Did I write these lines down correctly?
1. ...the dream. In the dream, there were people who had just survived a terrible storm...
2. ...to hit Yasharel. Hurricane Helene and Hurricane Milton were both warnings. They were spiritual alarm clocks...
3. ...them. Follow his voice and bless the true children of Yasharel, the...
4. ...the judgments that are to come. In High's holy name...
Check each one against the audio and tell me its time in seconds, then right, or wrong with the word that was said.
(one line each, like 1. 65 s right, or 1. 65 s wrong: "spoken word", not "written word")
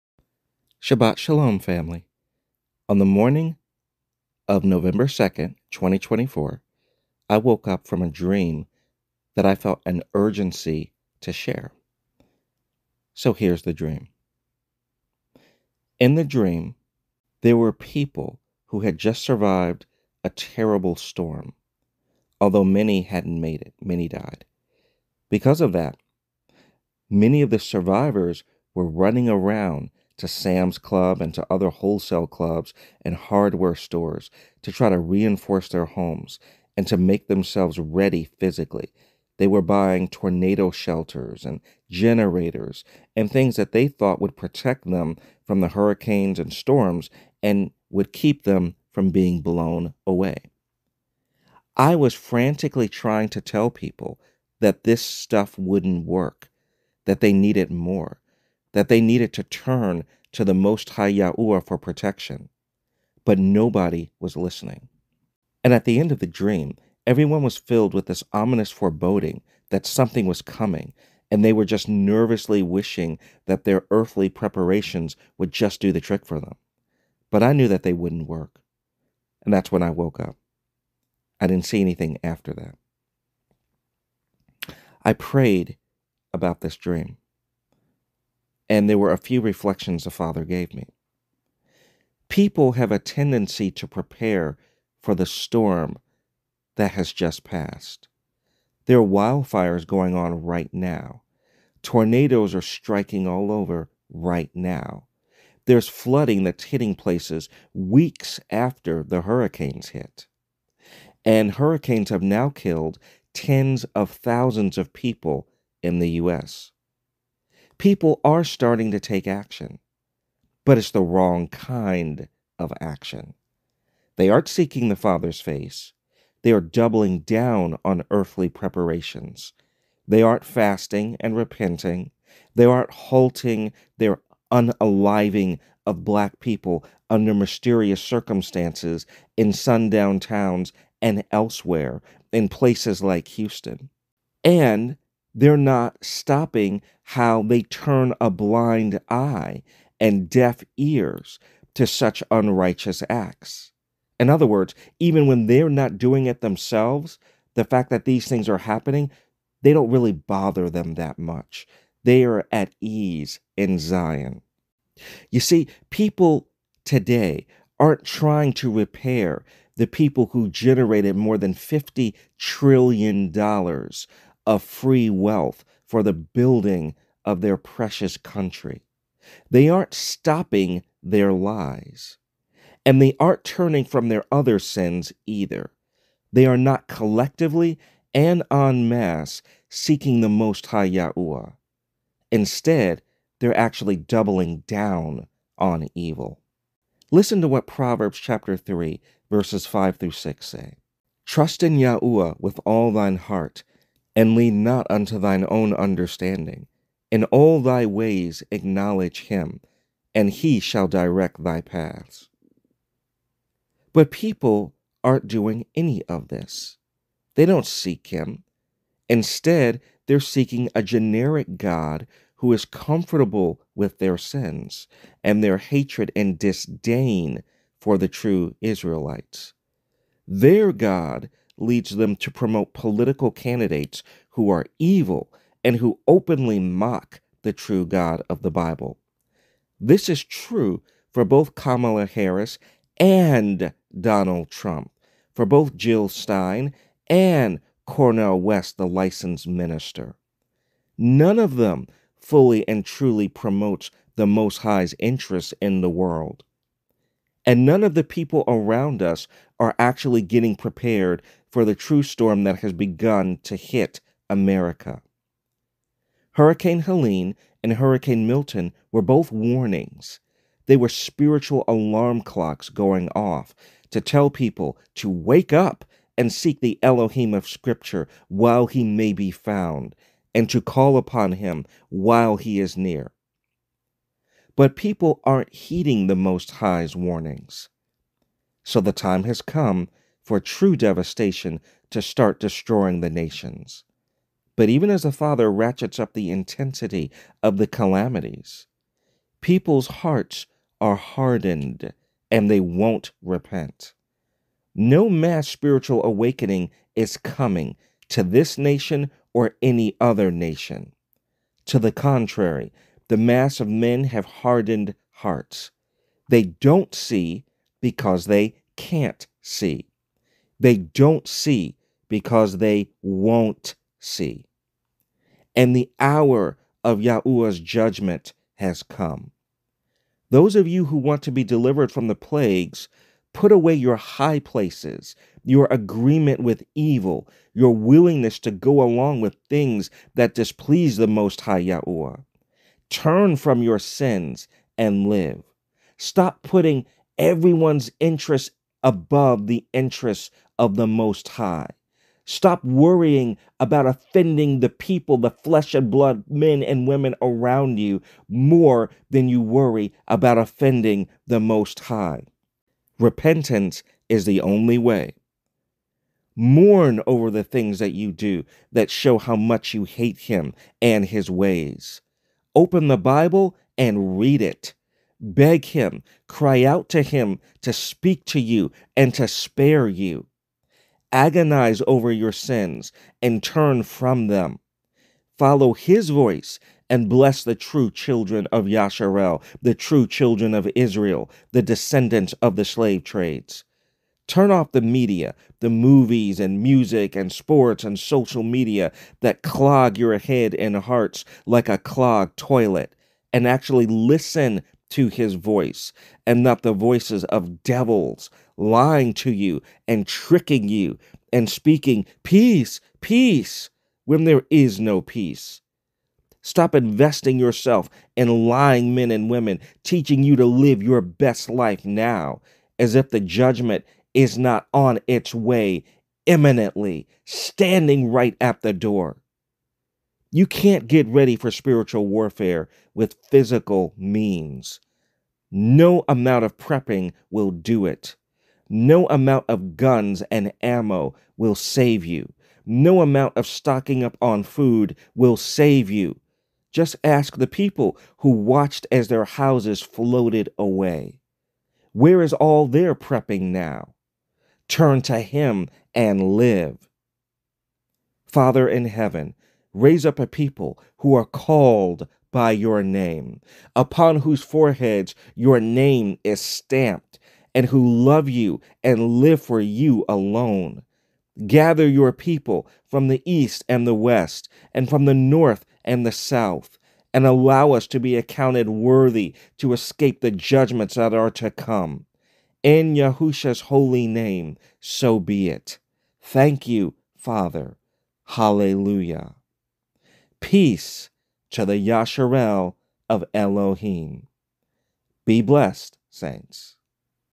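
1. 13 s right
2. 263 s wrong: "America", not "Yasharel"
3. 384 s right
4. 480 s wrong: "Yahusha", not "High".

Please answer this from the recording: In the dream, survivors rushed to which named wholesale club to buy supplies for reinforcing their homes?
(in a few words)
Sam's Club.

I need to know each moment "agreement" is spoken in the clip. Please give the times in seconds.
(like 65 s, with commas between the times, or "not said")
335 s.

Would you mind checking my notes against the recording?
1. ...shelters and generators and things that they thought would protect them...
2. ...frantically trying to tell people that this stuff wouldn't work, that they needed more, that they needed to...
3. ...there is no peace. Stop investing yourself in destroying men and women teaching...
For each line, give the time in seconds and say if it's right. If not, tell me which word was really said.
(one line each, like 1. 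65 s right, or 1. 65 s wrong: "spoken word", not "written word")
1. 40 s right
2. 52 s right
3. 414 s wrong: "lying", not "destroying".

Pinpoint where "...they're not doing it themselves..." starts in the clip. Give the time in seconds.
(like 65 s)
155 s.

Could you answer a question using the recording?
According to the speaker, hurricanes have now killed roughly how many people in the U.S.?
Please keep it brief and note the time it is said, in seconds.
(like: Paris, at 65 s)
tens of thousands, at 113 s.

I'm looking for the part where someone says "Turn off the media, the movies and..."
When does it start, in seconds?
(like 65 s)
394 s.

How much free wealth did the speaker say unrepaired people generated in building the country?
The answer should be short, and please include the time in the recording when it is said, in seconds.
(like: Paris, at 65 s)
More than $50 trillion, at 171 s.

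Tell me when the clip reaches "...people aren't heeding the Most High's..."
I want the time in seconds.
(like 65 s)
284 s.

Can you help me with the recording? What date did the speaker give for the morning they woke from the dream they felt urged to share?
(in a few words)
November 2nd, 2024.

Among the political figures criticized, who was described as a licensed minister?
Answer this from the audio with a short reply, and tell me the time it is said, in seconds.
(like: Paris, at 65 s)
Cornel West, at 247 s.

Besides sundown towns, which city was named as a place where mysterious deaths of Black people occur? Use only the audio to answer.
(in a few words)
Houston.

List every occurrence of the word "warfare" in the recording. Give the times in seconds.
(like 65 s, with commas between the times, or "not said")
432 s.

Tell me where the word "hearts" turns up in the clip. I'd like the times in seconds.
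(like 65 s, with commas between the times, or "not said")
203 s, 299 s, 315 s, 400 s.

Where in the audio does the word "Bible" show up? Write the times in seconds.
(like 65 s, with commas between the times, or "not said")
238 s, 372 s.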